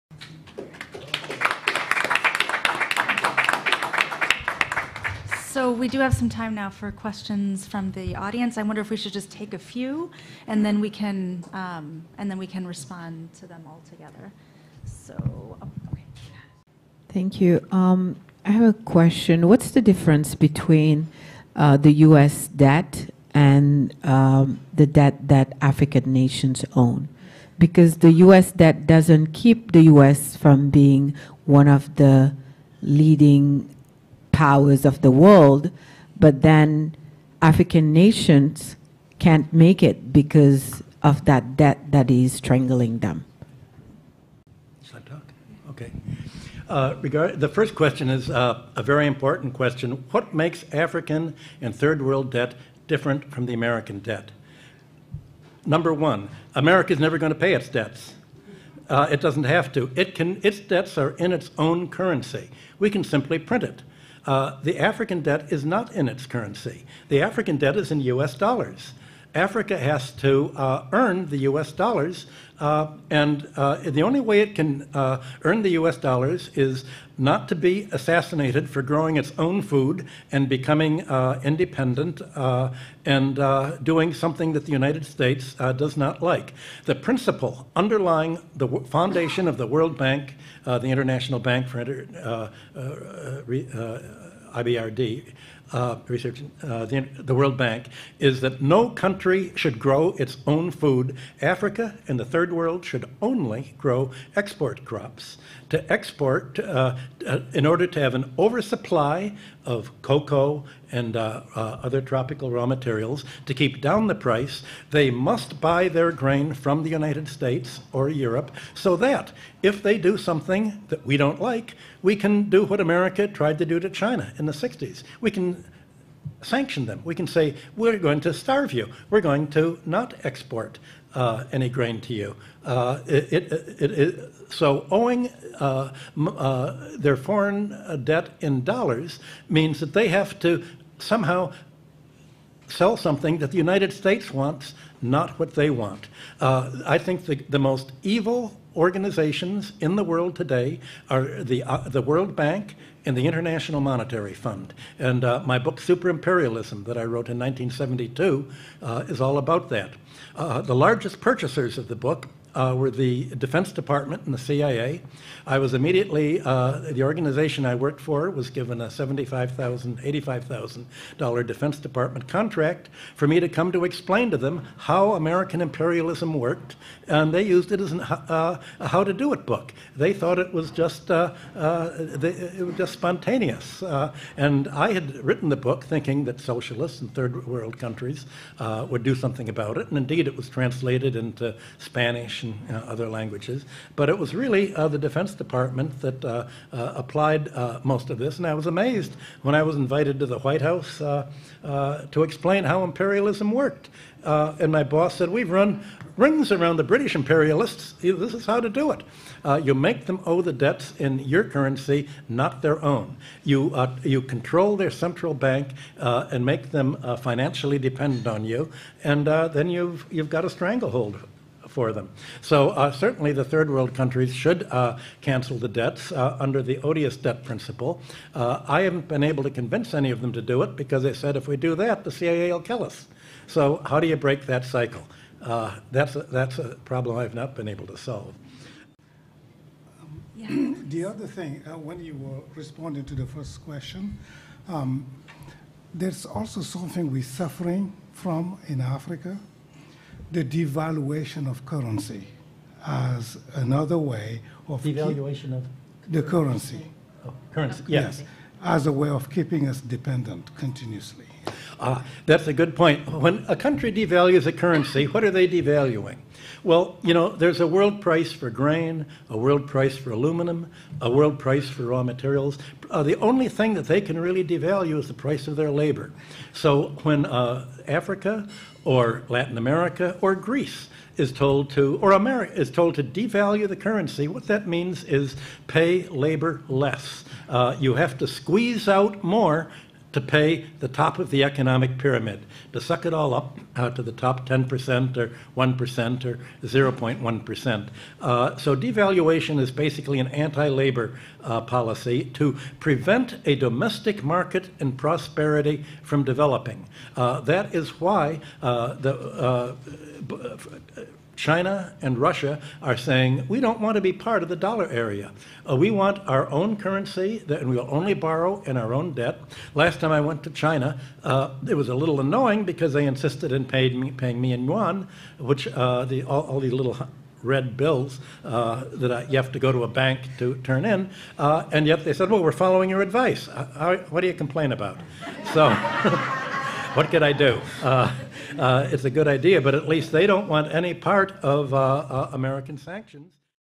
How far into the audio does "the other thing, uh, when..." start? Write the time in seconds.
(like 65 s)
240 s.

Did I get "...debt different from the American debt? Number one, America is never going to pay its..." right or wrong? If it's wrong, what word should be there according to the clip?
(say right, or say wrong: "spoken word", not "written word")
right.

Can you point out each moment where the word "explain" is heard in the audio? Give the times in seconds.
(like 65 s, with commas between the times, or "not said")
173 s, 202 s.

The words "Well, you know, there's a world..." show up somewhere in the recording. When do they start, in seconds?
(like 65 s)
266 s.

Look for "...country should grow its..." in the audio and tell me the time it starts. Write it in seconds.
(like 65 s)
98 s.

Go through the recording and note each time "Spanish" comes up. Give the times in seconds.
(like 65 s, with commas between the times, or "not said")
191 s.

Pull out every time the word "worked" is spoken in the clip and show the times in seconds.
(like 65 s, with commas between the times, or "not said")
167 s, 176 s, 203 s.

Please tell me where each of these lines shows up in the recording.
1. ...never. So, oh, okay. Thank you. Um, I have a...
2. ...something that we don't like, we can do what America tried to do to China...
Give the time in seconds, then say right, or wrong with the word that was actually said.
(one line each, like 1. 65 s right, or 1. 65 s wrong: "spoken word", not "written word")
1. 13 s wrong: "together", not "never"
2. 120 s right.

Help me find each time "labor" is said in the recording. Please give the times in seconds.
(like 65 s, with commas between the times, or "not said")
275 s, 286 s, 300 s.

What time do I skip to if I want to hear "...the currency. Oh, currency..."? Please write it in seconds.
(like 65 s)
256 s.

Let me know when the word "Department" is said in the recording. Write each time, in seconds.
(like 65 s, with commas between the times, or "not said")
163 s, 171 s, 195 s.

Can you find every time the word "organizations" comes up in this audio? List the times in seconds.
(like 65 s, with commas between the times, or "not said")
148 s, 167 s.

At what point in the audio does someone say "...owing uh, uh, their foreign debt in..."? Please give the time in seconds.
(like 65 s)
134 s.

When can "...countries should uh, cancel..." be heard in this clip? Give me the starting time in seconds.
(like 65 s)
223 s.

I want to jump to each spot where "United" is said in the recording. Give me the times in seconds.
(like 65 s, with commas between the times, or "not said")
84 s, 116 s, 143 s.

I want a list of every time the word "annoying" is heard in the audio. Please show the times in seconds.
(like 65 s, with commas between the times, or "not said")
322 s.